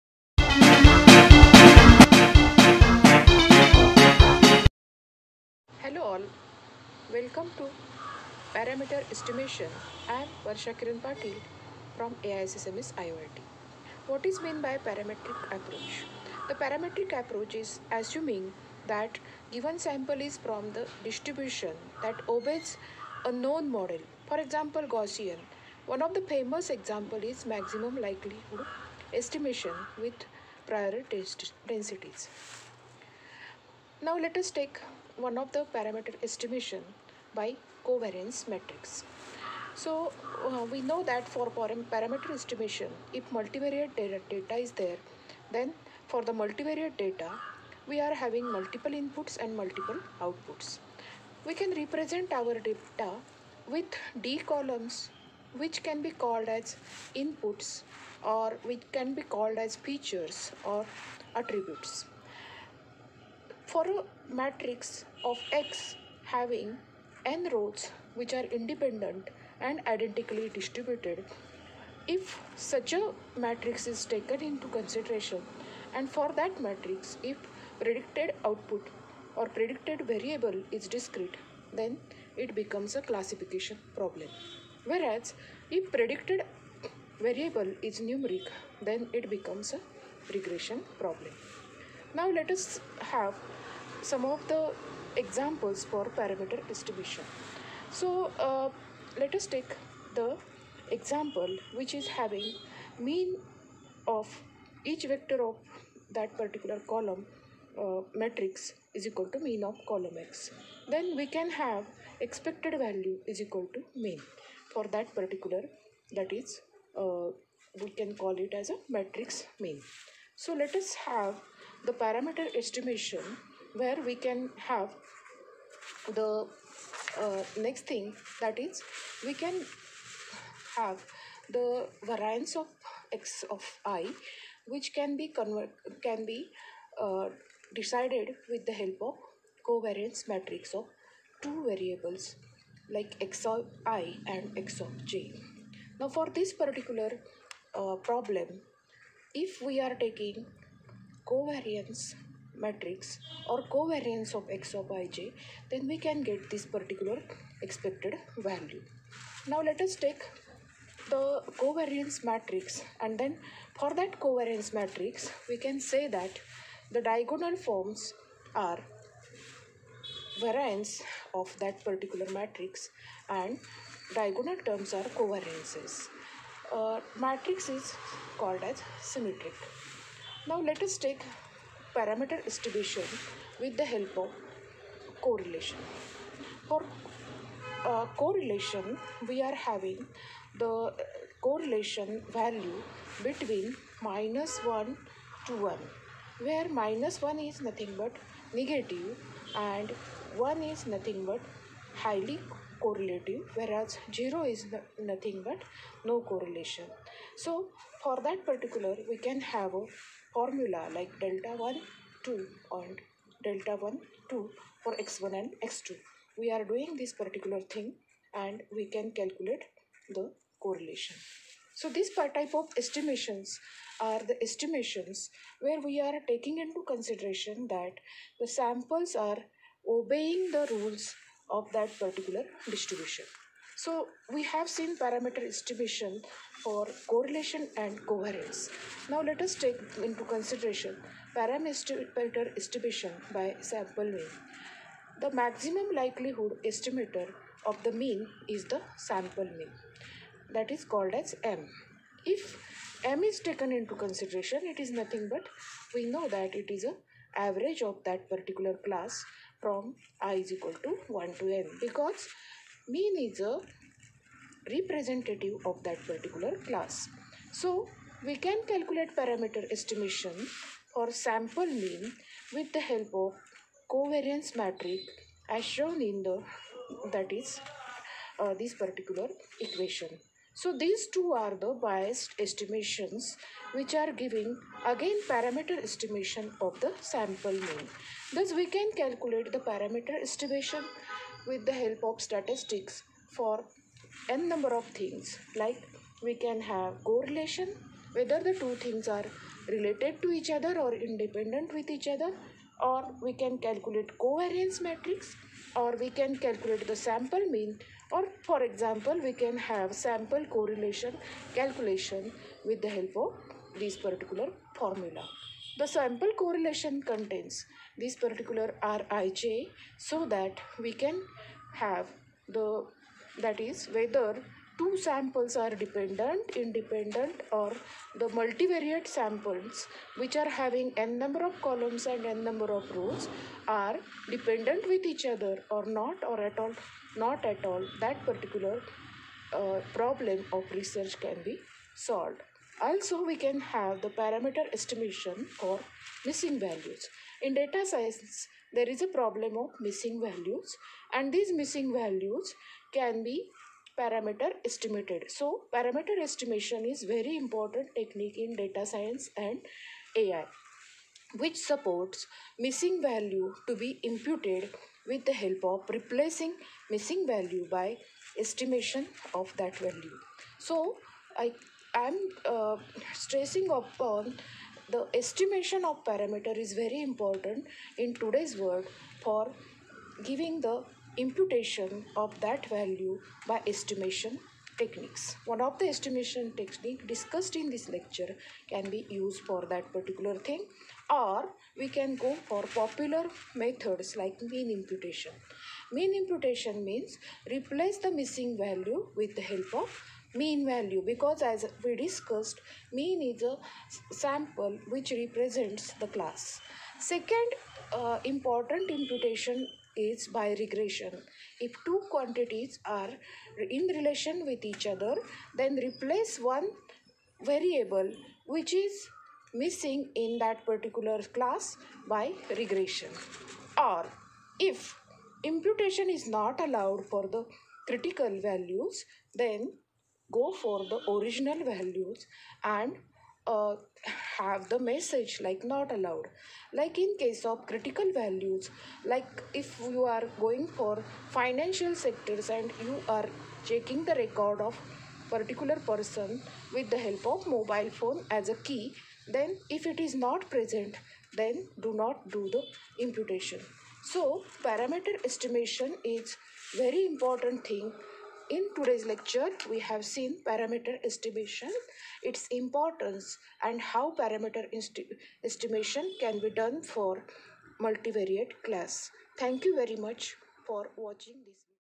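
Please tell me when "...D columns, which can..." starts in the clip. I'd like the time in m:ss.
0:54.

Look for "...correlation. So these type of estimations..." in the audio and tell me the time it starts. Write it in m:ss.
3:40.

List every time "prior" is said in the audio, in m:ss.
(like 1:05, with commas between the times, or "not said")
0:30.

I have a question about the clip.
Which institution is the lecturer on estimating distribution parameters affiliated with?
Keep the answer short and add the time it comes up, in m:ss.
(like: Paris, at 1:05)
AISSMS IOIT, at 0:12.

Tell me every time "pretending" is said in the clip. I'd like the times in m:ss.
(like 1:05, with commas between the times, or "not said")
not said.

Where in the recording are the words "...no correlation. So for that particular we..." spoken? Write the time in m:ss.
3:26.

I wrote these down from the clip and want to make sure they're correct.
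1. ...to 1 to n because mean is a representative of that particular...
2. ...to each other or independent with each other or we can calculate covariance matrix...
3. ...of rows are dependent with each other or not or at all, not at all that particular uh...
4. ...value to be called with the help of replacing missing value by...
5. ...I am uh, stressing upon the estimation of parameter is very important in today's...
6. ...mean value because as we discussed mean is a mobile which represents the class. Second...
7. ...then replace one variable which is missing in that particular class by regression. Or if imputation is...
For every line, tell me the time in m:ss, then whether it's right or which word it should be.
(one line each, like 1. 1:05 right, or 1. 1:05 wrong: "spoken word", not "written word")
1. 4:20 right
2. 5:00 right
3. 5:32 right
4. 6:03 wrong: "imputed", not "called"
5. 6:11 right
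6. 6:40 wrong: "sample", not "mobile"
7. 6:55 right.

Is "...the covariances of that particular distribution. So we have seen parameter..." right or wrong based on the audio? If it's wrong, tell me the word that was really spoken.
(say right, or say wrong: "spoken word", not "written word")
wrong: "rules", not "covariances".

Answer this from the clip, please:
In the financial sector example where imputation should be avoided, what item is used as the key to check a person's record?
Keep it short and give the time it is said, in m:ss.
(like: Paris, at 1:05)
Mobile phone, at 7:27.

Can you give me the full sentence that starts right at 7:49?
Thank you very much for watching this.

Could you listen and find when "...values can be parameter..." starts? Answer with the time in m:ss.
5:51.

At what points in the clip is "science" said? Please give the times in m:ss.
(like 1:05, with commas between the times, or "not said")
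5:47, 5:58.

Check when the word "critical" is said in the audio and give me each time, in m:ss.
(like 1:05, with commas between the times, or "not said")
7:07, 7:17.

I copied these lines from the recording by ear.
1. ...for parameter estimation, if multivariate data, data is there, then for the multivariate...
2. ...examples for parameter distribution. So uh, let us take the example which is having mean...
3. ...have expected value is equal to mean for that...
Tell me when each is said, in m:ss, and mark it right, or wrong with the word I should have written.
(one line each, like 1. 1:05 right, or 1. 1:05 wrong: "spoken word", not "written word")
1. 0:41 right
2. 1:35 right
3. 1:51 right.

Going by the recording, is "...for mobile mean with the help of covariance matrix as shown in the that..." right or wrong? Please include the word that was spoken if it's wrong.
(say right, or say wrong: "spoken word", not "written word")
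wrong: "sample", not "mobile".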